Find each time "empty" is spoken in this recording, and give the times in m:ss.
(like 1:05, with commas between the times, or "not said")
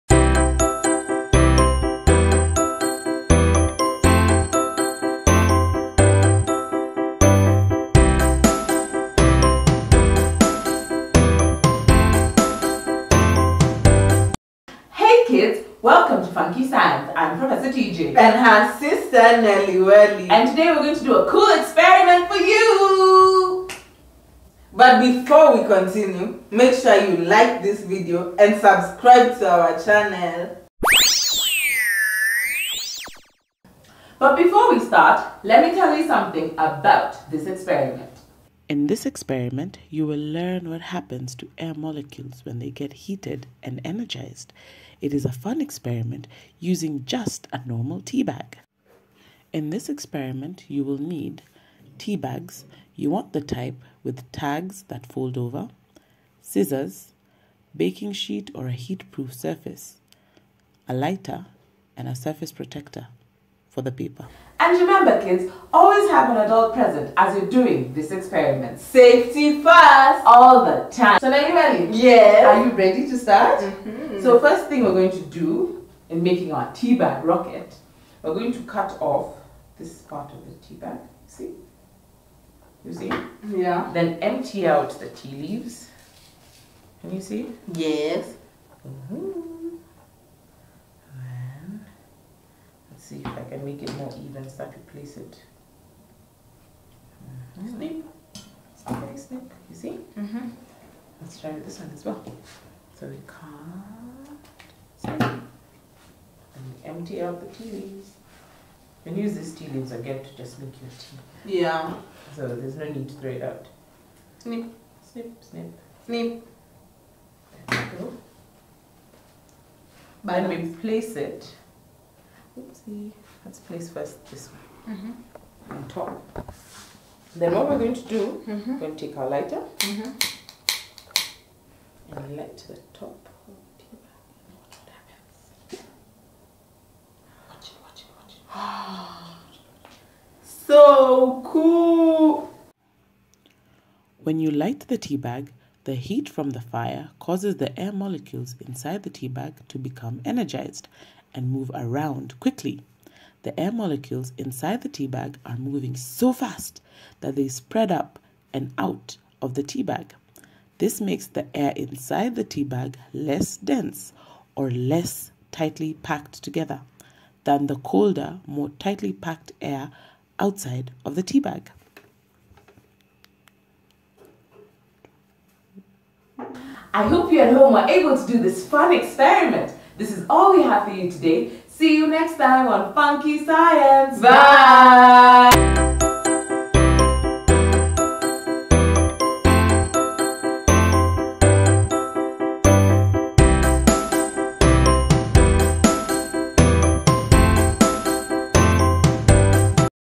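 1:24, 1:46.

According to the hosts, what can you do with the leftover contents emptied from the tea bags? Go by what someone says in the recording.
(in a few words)
Make your tea.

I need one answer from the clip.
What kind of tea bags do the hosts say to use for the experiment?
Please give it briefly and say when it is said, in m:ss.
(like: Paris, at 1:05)
The type with tags that fold over, at 0:54.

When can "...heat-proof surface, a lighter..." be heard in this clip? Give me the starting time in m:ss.
0:58.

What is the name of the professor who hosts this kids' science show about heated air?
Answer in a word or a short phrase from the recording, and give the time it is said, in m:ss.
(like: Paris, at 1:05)
Professor TJ, at 0:17.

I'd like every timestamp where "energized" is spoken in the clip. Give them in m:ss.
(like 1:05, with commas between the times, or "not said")
0:43, 2:30.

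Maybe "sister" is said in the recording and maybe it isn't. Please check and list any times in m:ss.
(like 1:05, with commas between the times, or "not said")
0:18.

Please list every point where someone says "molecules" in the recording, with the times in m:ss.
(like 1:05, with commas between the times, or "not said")
0:41, 2:27, 2:33.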